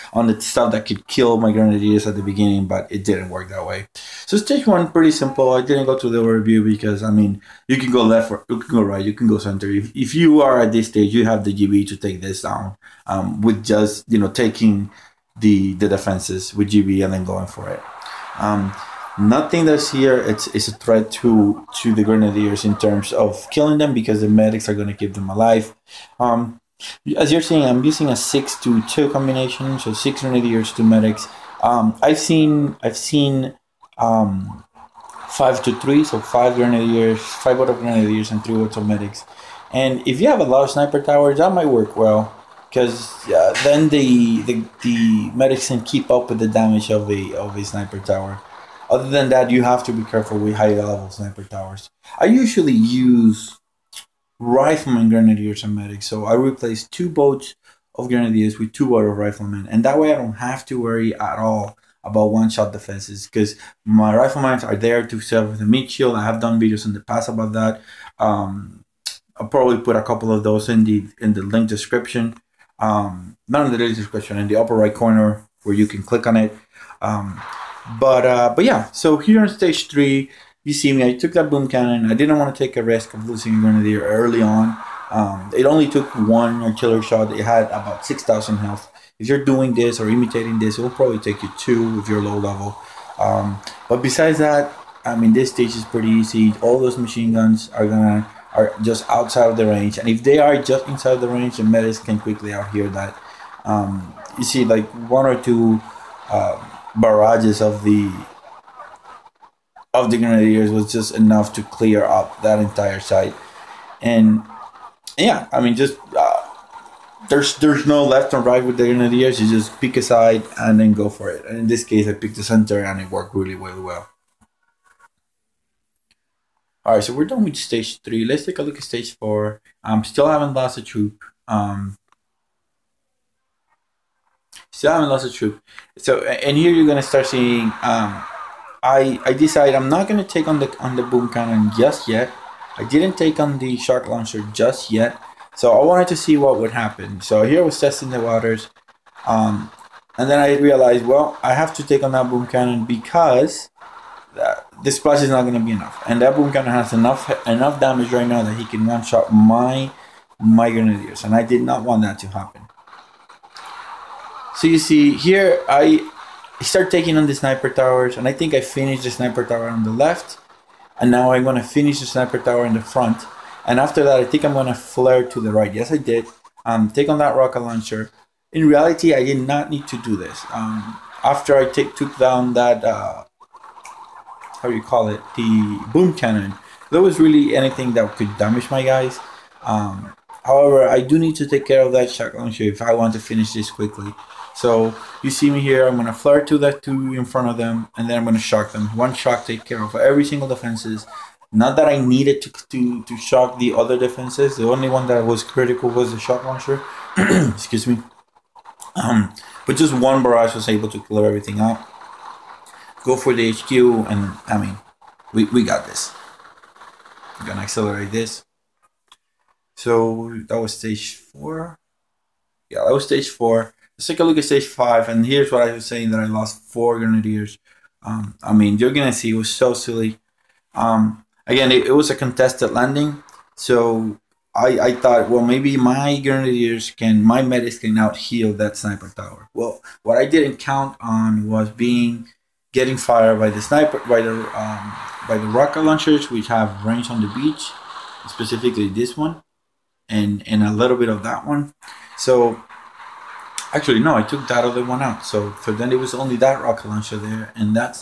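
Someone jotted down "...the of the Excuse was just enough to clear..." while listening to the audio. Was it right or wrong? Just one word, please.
wrong.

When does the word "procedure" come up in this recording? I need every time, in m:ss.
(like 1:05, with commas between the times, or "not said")
not said.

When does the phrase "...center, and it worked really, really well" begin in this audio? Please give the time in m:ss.
2:02.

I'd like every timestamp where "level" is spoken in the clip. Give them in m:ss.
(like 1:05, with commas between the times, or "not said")
0:50, 1:32.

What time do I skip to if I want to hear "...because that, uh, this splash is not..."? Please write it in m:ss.
2:32.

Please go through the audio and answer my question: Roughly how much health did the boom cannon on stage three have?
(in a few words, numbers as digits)
6000.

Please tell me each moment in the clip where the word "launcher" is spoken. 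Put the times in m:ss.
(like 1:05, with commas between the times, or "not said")
2:24, 2:57, 3:12, 3:26, 4:05, 4:16.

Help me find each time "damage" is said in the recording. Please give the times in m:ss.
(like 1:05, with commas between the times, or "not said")
0:46, 2:37, 3:08.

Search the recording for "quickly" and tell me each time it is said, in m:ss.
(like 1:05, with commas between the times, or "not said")
1:42, 3:13.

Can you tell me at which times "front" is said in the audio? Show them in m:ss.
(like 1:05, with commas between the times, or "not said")
2:52, 3:17.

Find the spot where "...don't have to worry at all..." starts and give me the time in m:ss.
1:00.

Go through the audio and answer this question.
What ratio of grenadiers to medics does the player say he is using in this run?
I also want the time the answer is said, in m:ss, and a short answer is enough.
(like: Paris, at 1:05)
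6 to 2, at 0:28.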